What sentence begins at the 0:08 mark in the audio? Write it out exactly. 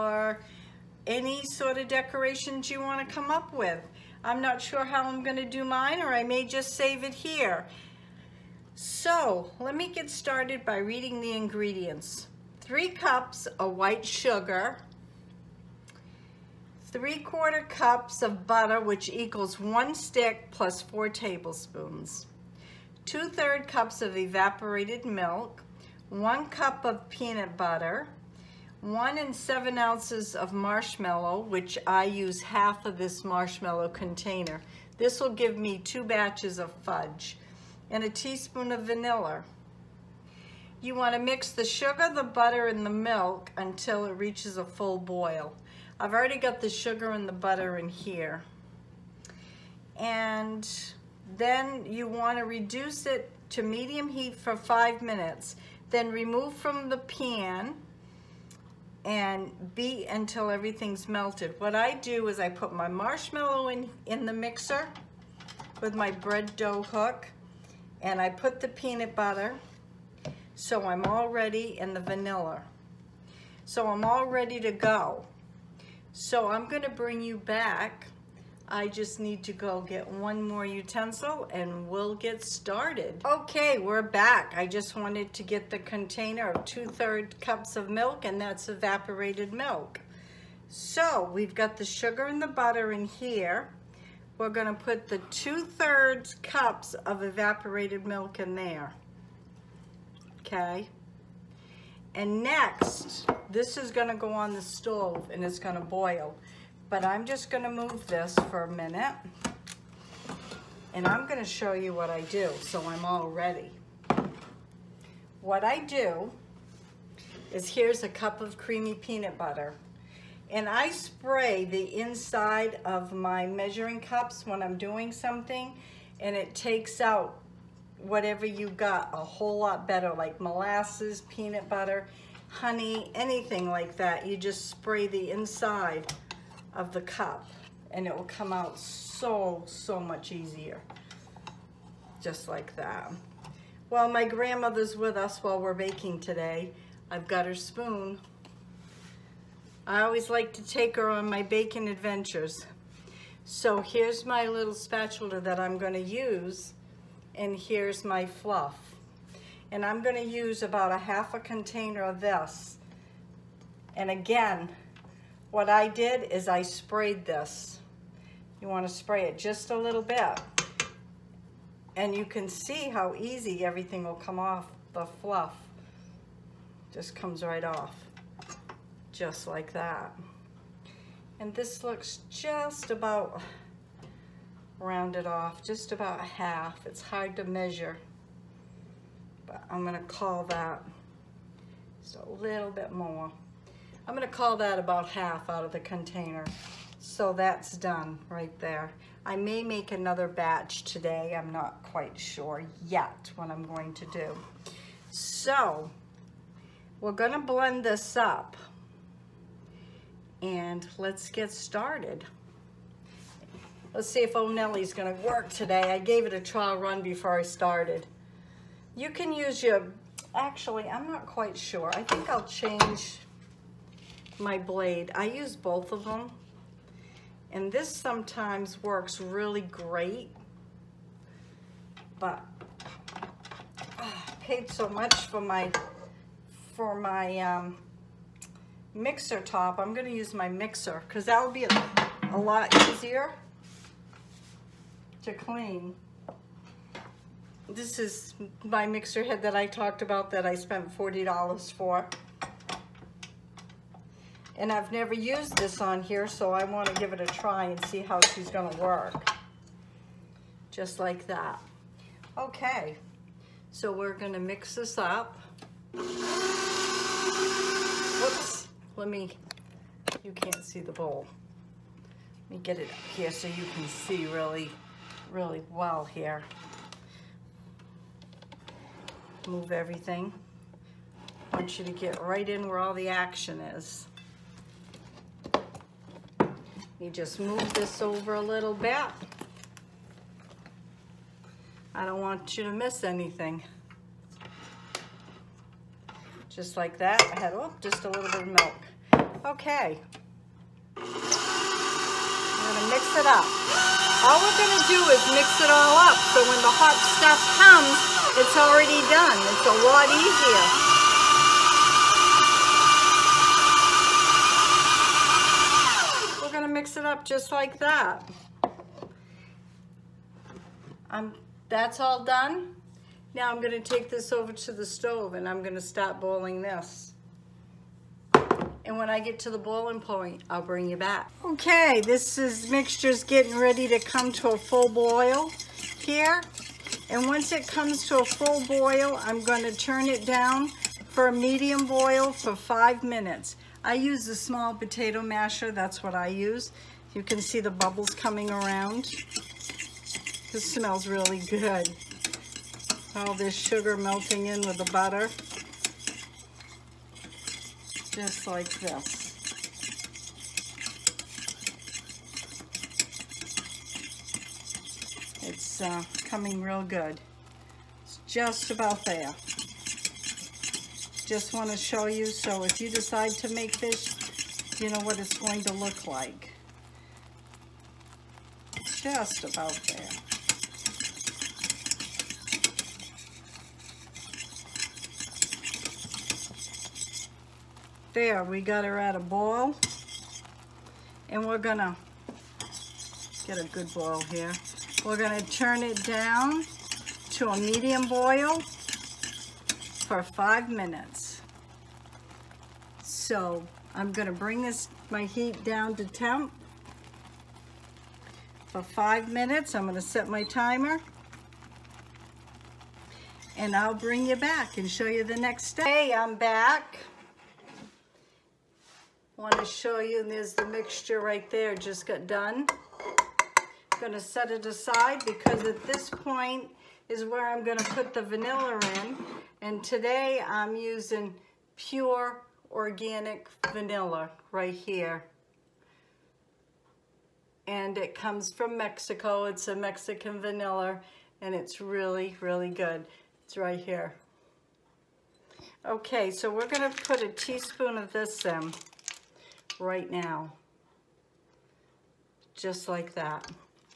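So let me get started by reading the ingredients.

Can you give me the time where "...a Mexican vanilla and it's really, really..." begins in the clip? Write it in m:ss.
7:19.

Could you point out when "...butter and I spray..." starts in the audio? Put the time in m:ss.
1:59.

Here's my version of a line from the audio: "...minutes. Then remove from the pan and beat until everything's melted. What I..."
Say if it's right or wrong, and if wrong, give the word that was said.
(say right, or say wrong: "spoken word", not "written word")
right.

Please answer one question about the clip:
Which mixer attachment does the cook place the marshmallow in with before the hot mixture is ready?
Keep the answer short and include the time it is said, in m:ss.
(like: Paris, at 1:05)
bread dough hook, at 1:06.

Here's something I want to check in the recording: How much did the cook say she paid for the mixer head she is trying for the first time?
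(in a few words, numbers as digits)
$40.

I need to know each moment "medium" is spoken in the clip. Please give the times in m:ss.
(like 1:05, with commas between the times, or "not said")
0:53, 5:41, 6:37.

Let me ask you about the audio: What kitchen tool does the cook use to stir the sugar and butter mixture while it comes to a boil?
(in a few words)
small potato masher.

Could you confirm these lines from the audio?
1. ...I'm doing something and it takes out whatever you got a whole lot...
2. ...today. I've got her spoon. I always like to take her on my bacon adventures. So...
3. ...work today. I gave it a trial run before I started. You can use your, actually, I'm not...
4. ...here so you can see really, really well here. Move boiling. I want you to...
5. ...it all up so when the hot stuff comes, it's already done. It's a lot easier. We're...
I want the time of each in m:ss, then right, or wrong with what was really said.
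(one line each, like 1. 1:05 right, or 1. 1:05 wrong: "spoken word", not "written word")
1. 2:04 right
2. 2:26 right
3. 3:35 right
4. 4:33 wrong: "everything", not "boiling"
5. 5:05 right.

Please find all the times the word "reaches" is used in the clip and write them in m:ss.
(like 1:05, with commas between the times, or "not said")
0:44.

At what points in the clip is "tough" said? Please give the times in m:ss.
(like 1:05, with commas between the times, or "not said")
not said.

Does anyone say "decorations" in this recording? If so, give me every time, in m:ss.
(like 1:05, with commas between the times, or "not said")
0:01.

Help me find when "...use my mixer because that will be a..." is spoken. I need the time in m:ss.
4:00.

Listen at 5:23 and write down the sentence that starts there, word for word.
Now I'm going to take this over to the stove and I'm going to start boiling this.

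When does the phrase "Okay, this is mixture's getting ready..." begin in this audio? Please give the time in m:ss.
5:31.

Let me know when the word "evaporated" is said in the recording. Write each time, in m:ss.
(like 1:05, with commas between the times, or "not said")
0:24, 1:28, 1:37.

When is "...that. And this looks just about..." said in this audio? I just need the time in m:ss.
2:59.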